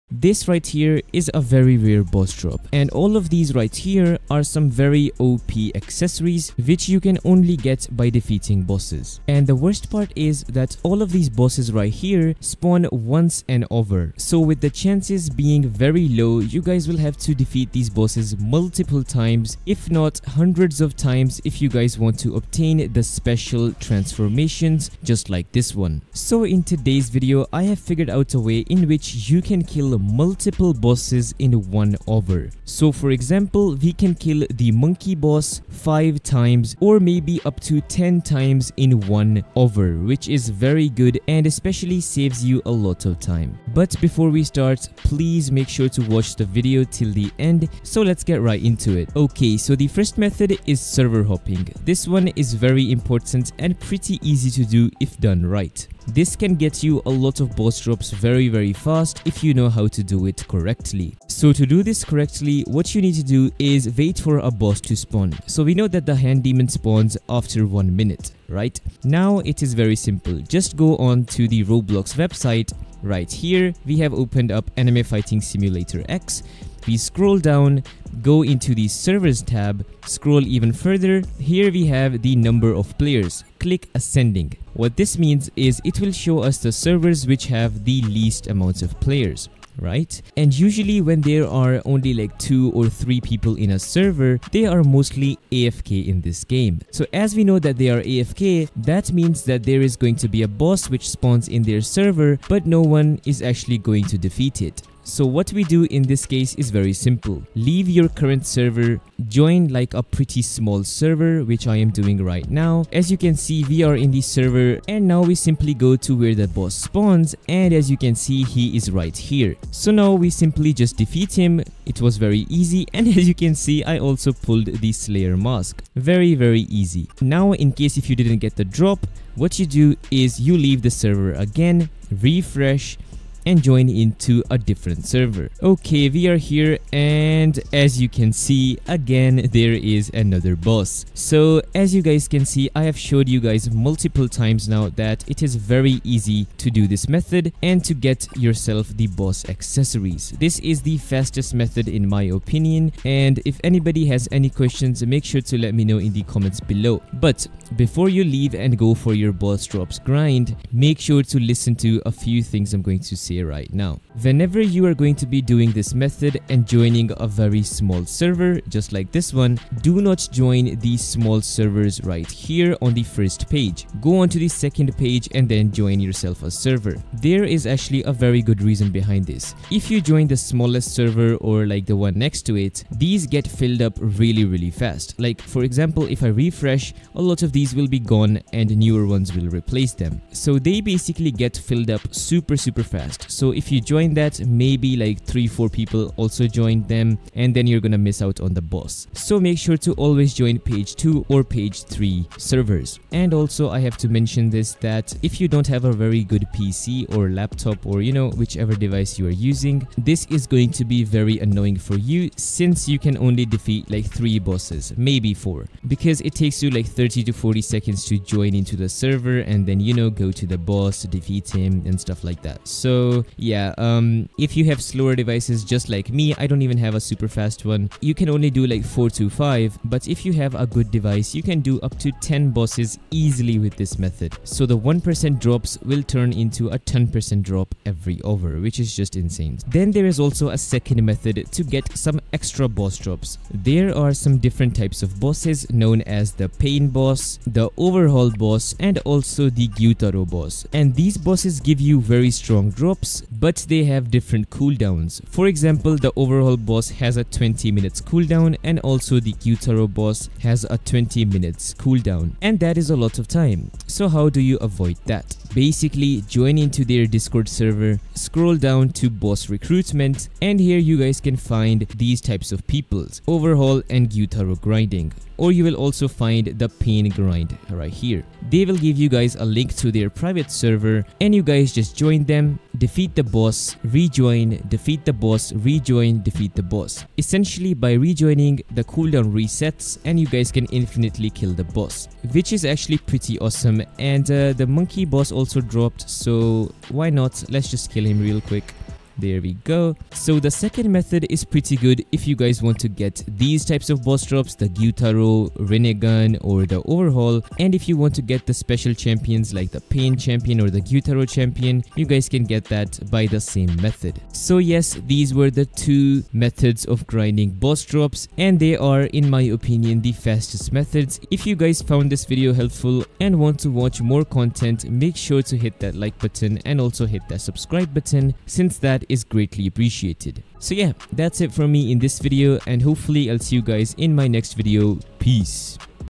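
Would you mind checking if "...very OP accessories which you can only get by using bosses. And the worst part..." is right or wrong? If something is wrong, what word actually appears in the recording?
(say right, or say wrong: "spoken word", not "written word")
wrong: "defeating", not "using".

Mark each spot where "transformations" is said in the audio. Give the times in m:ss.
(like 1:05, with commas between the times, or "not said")
0:23.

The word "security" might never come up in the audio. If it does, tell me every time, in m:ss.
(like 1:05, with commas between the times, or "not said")
not said.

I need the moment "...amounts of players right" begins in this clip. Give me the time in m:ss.
1:28.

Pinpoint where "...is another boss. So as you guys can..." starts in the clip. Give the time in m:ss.
2:19.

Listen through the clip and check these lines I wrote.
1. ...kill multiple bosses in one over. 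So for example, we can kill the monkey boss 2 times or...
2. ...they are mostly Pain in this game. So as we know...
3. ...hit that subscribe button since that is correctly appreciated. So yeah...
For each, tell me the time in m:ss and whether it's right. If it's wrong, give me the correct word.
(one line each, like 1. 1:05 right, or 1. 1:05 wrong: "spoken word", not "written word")
1. 0:29 wrong: "5", not "2"
2. 1:34 wrong: "AFK", not "Pain"
3. 5:27 wrong: "greatly", not "correctly".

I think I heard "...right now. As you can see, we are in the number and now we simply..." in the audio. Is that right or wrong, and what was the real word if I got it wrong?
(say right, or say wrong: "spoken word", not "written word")
wrong: "server", not "number".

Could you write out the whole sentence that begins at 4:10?
And these bosses give you very strong drops but they have different cooldowns.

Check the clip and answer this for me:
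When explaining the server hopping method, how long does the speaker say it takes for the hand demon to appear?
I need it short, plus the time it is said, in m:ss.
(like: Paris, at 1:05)
1 minute, at 1:07.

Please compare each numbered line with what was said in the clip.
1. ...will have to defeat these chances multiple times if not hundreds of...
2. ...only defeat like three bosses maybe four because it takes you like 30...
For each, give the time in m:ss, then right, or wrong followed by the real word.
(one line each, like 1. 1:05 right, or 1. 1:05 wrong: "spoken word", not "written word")
1. 0:16 wrong: "bosses", not "chances"
2. 3:33 right.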